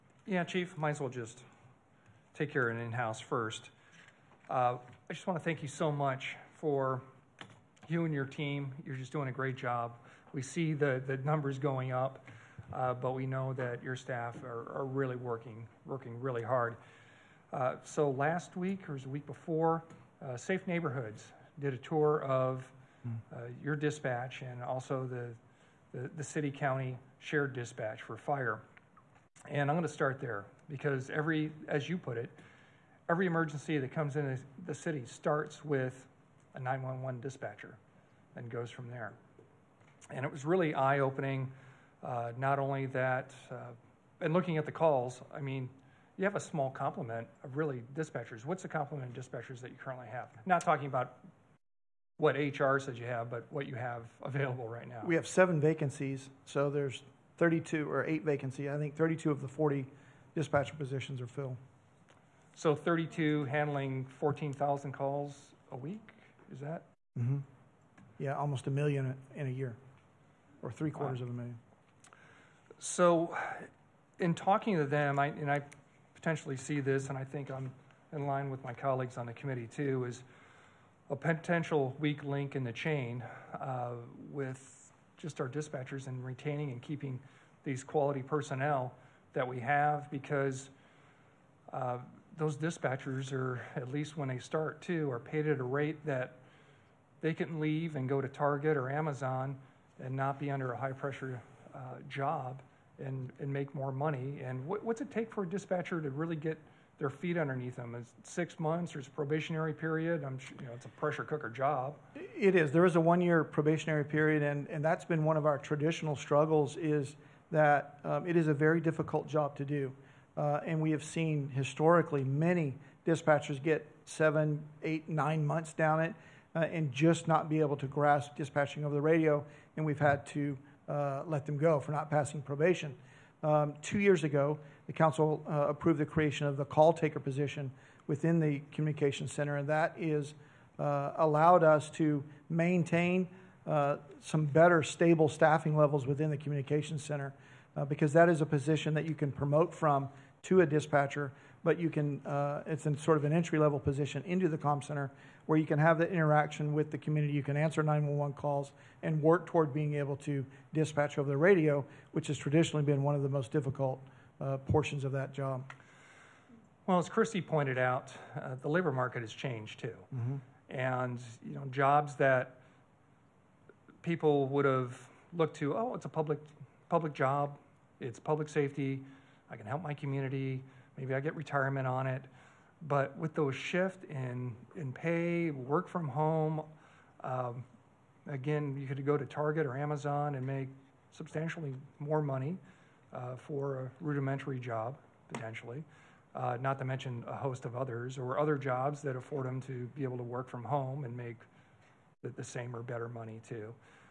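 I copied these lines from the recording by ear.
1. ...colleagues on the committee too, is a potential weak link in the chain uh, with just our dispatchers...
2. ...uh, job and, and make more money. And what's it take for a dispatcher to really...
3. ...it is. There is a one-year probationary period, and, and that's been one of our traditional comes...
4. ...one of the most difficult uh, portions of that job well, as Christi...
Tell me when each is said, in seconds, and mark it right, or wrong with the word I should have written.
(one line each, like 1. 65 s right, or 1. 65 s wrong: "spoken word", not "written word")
1. 78 s right
2. 101 s right
3. 112 s wrong: "struggles", not "comes"
4. 163 s right.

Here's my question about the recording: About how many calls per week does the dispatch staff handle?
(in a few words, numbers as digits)
14,000.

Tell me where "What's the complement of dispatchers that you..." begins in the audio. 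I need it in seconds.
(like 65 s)
48 s.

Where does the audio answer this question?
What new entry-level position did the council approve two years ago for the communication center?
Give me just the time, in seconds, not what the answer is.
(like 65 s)
136 s.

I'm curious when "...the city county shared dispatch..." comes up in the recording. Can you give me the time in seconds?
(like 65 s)
26 s.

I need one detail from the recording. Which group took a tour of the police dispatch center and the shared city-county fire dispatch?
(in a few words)
Safe Neighborhoods.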